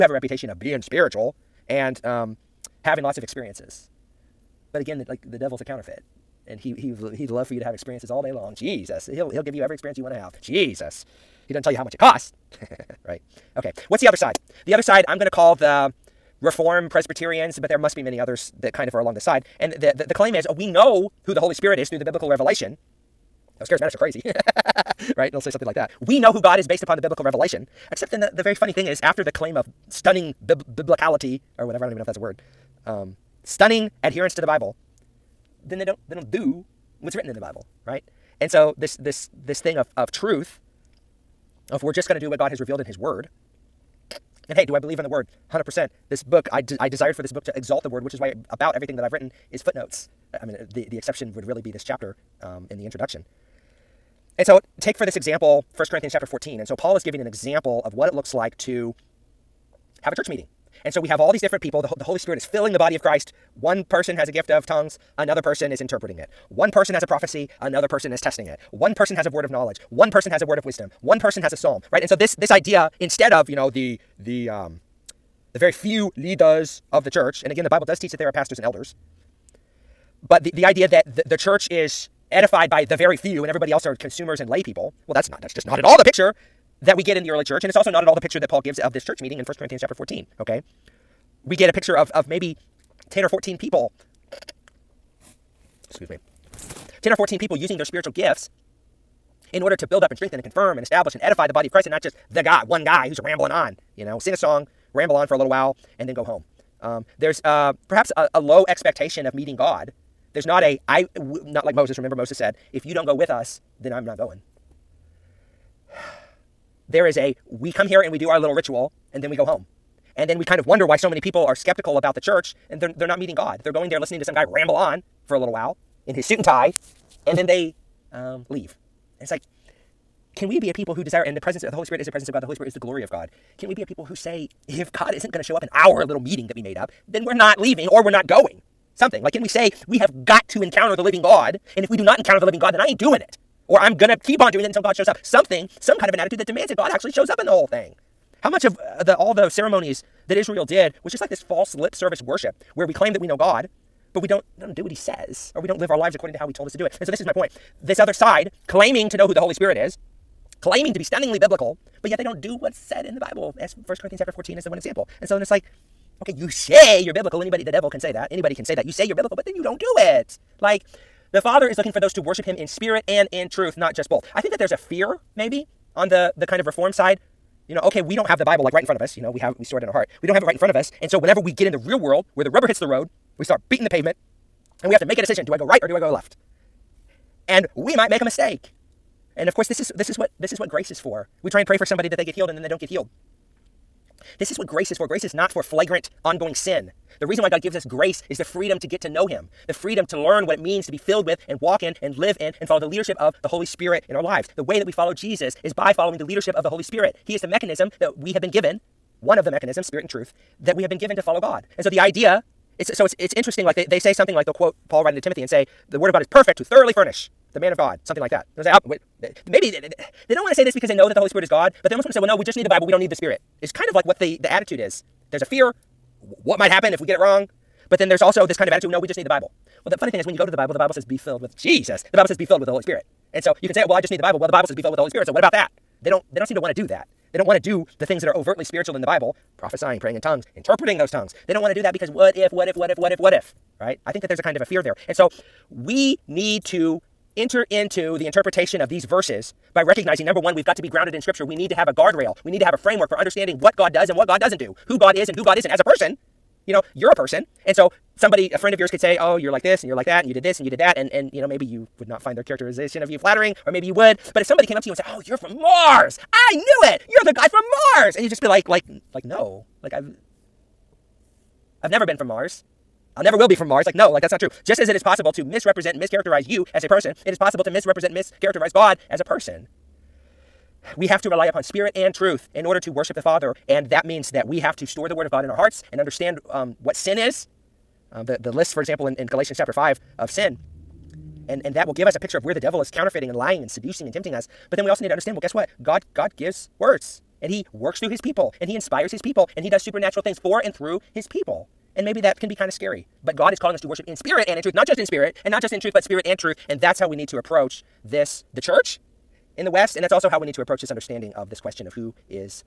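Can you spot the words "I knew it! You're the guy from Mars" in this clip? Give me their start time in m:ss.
4:26.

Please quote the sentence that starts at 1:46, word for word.
Um, there's uh, perhaps a, a low expectation of meeting God.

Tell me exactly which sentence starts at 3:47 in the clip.
But then there's also this kind of attitude no, we just need the Bible.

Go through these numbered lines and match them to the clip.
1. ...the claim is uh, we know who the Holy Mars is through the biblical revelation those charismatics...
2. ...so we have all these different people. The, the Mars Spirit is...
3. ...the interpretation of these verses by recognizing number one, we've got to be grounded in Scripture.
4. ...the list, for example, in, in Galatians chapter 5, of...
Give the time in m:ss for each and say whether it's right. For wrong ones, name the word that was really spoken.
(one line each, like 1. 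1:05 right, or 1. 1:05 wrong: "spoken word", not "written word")
1. 0:20 wrong: "Spirit", not "Mars"
2. 1:00 wrong: "Holy", not "Mars"
3. 4:08 right
4. 4:48 right.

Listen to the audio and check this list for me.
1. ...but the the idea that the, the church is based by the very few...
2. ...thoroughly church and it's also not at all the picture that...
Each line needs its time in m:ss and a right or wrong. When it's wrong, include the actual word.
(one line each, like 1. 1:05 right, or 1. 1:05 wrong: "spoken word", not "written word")
1. 1:20 wrong: "edified", not "based"
2. 1:27 wrong: "early", not "thoroughly".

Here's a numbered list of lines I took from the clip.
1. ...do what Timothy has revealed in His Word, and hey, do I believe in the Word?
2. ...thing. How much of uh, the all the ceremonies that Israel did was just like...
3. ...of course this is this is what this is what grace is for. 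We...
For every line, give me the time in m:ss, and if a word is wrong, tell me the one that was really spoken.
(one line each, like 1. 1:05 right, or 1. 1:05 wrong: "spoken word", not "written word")
1. 0:42 wrong: "God", not "Timothy"
2. 2:27 right
3. 3:09 right.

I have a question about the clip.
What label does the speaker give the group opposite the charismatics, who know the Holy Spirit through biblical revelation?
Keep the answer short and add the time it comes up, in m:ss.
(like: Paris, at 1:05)
Reform Presbyterians, at 0:16.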